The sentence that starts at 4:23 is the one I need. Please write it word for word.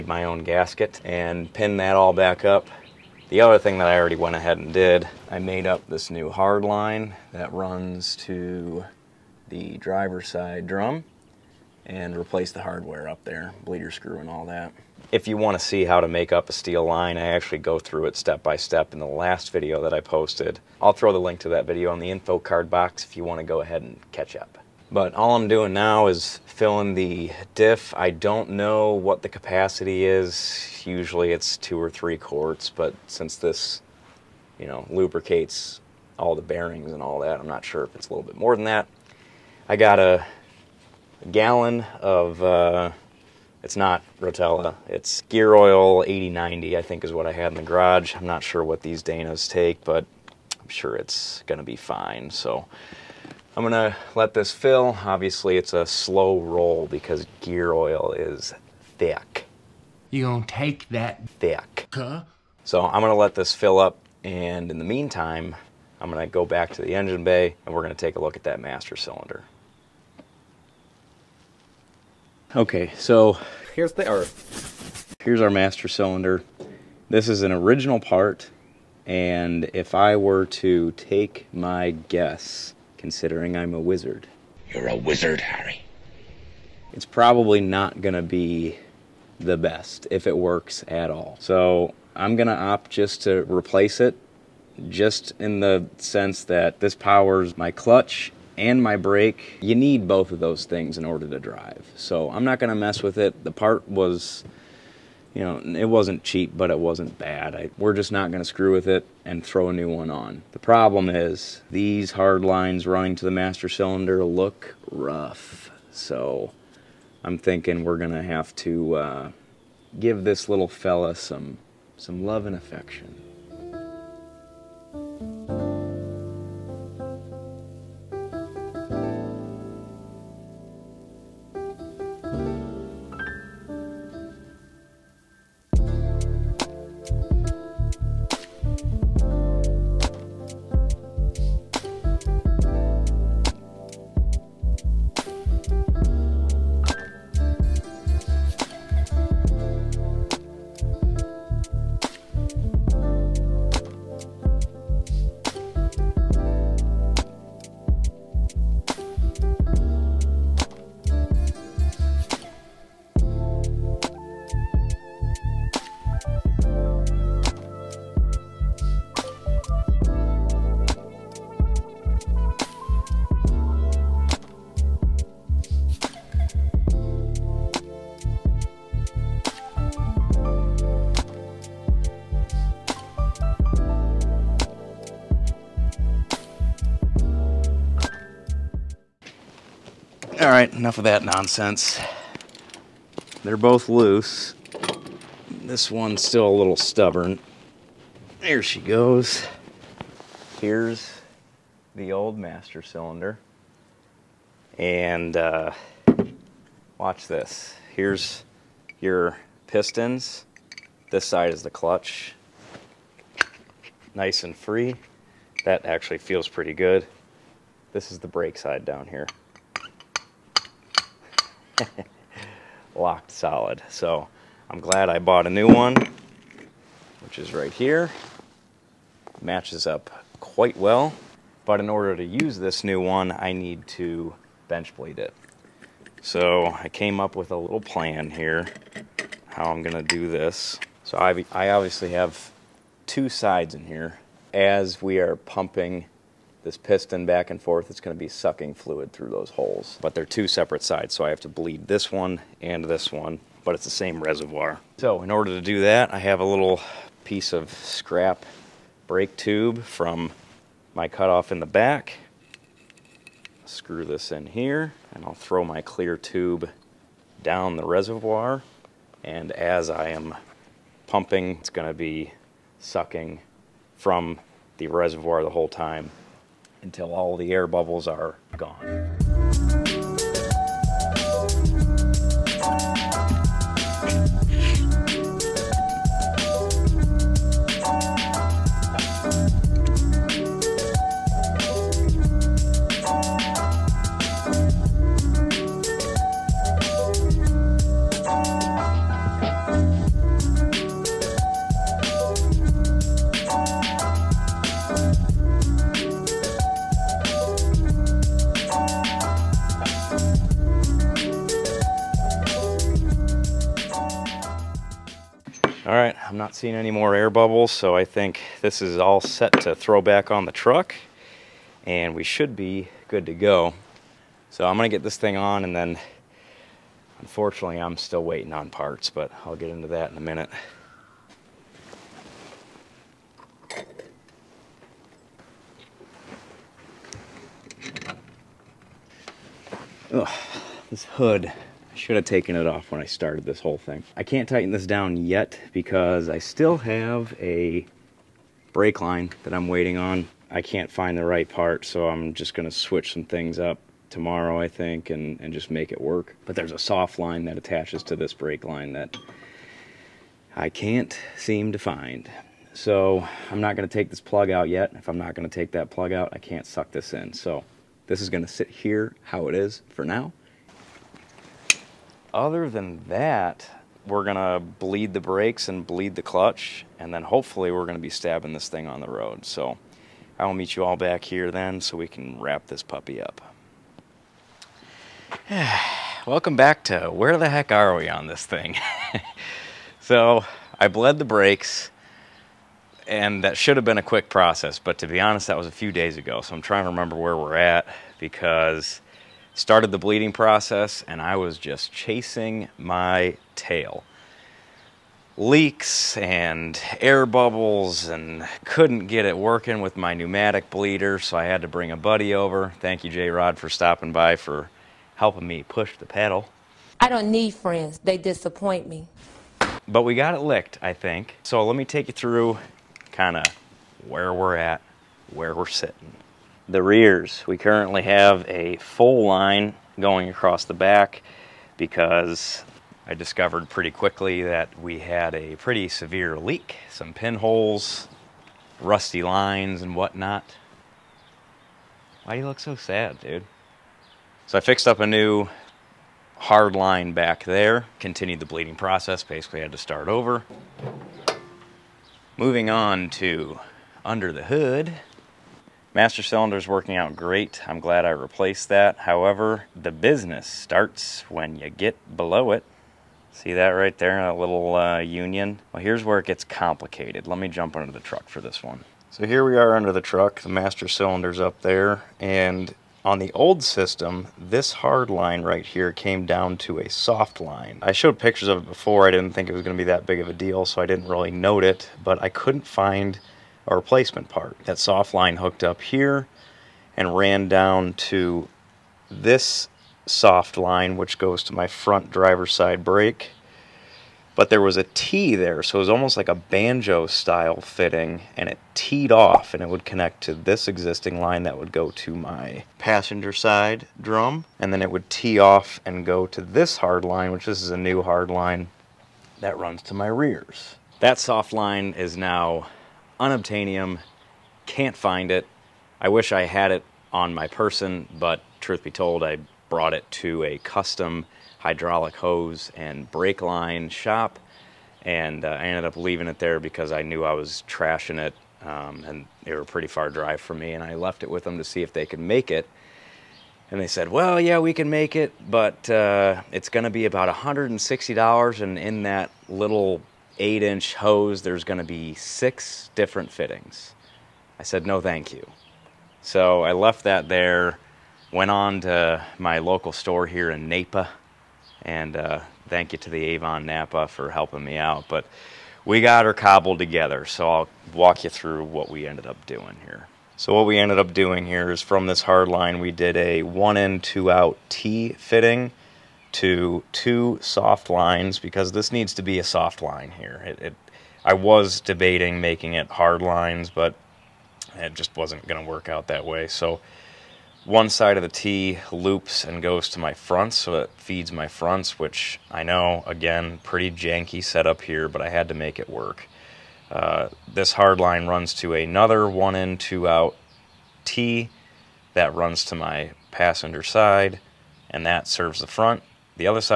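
Screw this in here, and I'll throw my clear tube down the reservoir.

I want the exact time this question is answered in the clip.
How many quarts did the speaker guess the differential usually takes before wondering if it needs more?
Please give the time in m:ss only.
0:31.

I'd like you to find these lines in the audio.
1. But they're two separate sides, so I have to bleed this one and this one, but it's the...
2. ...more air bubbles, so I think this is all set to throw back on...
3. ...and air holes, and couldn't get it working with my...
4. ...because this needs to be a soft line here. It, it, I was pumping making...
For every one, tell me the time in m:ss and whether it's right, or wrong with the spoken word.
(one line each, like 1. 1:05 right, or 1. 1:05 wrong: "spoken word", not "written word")
1. 4:10 right
2. 5:16 right
3. 6:46 wrong: "bubbles", not "holes"
4. 9:28 wrong: "debating", not "pumping".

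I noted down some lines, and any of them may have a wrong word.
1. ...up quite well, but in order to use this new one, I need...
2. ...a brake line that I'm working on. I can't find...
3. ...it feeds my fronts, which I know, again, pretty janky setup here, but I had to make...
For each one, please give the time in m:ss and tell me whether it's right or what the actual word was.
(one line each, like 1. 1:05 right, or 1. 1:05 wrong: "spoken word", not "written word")
1. 3:49 right
2. 5:47 wrong: "waiting", not "working"
3. 9:40 right.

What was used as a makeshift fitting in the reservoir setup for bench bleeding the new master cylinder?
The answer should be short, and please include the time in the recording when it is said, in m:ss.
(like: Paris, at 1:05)
Scrap brake tube, at 4:17.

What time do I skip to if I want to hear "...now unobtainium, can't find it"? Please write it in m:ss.
8:32.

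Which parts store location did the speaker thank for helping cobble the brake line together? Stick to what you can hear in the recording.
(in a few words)
Avon Napa.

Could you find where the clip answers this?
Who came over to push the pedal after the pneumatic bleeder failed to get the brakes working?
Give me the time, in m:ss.
6:53.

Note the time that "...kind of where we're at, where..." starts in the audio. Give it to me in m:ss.
7:03.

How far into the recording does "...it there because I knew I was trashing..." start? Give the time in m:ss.
8:46.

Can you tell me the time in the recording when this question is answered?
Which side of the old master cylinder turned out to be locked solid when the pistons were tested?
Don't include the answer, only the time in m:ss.
3:38.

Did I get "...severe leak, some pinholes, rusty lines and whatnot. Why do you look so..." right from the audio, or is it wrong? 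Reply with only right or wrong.
right.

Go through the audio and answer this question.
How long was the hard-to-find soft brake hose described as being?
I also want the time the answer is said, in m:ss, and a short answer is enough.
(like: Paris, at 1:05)
8 inches, at 9:00.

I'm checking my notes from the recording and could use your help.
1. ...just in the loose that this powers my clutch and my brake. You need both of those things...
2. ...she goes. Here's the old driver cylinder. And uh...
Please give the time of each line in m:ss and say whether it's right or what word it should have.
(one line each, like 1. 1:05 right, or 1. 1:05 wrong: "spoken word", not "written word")
1. 1:34 wrong: "sense", not "loose"
2. 3:18 wrong: "master", not "driver".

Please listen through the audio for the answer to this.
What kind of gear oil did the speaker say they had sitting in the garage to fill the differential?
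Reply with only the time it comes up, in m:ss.
0:45.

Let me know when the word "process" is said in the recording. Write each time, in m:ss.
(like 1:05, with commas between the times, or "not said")
6:34, 6:40, 7:28.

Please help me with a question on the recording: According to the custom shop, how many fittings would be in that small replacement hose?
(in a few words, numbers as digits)
6.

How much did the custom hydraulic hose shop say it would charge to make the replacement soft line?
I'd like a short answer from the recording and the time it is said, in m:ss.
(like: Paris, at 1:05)
$160, at 8:57.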